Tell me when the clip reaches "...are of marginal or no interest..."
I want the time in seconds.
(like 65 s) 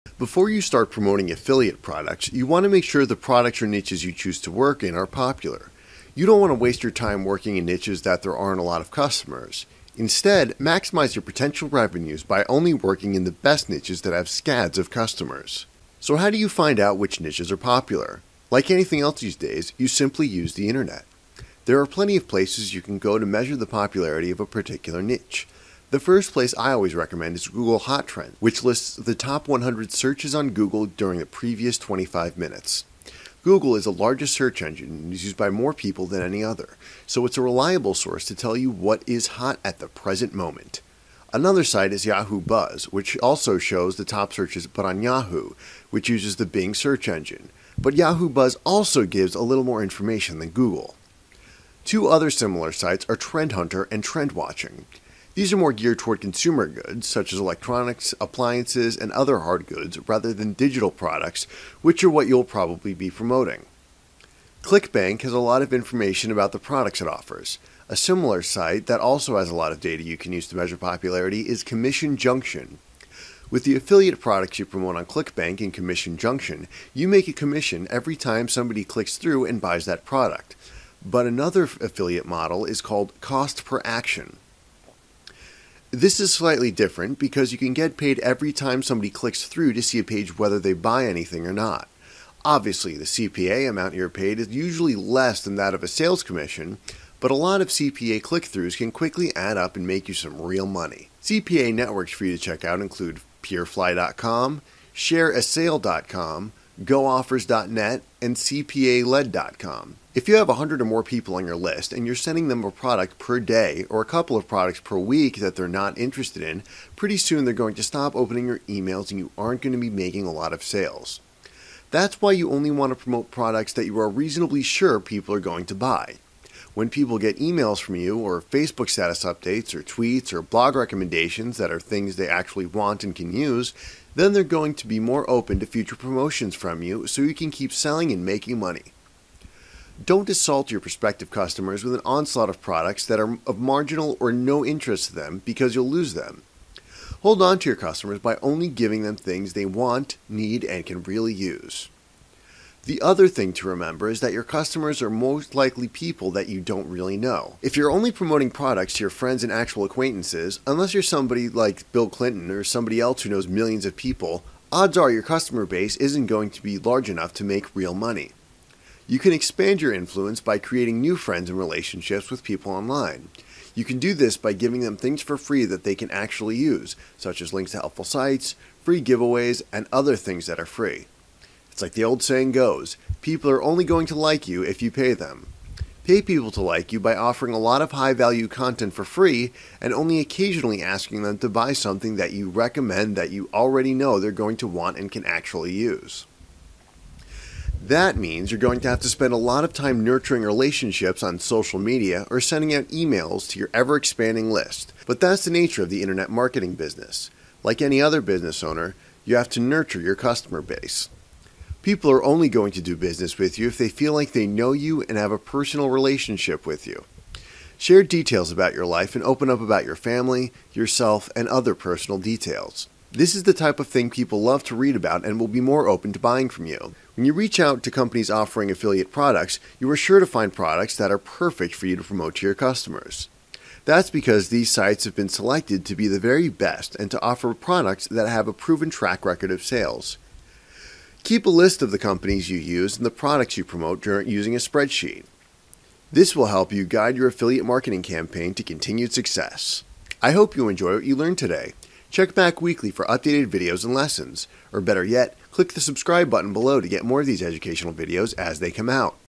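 143 s.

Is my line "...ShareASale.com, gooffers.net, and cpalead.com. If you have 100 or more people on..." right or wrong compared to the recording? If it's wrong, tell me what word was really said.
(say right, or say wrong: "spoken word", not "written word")
right.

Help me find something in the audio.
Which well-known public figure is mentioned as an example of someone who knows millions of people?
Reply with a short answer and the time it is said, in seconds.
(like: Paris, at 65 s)
Bill Clinton, at 161 s.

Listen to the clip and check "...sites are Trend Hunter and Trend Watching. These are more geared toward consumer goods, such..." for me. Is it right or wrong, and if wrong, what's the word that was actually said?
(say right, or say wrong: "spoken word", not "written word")
right.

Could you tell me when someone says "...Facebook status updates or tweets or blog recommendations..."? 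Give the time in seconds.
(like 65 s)
128 s.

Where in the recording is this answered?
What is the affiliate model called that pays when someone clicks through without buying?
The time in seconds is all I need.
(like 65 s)
83 s.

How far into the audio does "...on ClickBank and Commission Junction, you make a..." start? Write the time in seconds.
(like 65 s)
74 s.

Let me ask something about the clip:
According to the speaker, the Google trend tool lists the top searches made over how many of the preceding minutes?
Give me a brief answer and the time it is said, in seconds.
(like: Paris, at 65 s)
25, at 31 s.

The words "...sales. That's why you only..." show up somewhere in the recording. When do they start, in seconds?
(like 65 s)
120 s.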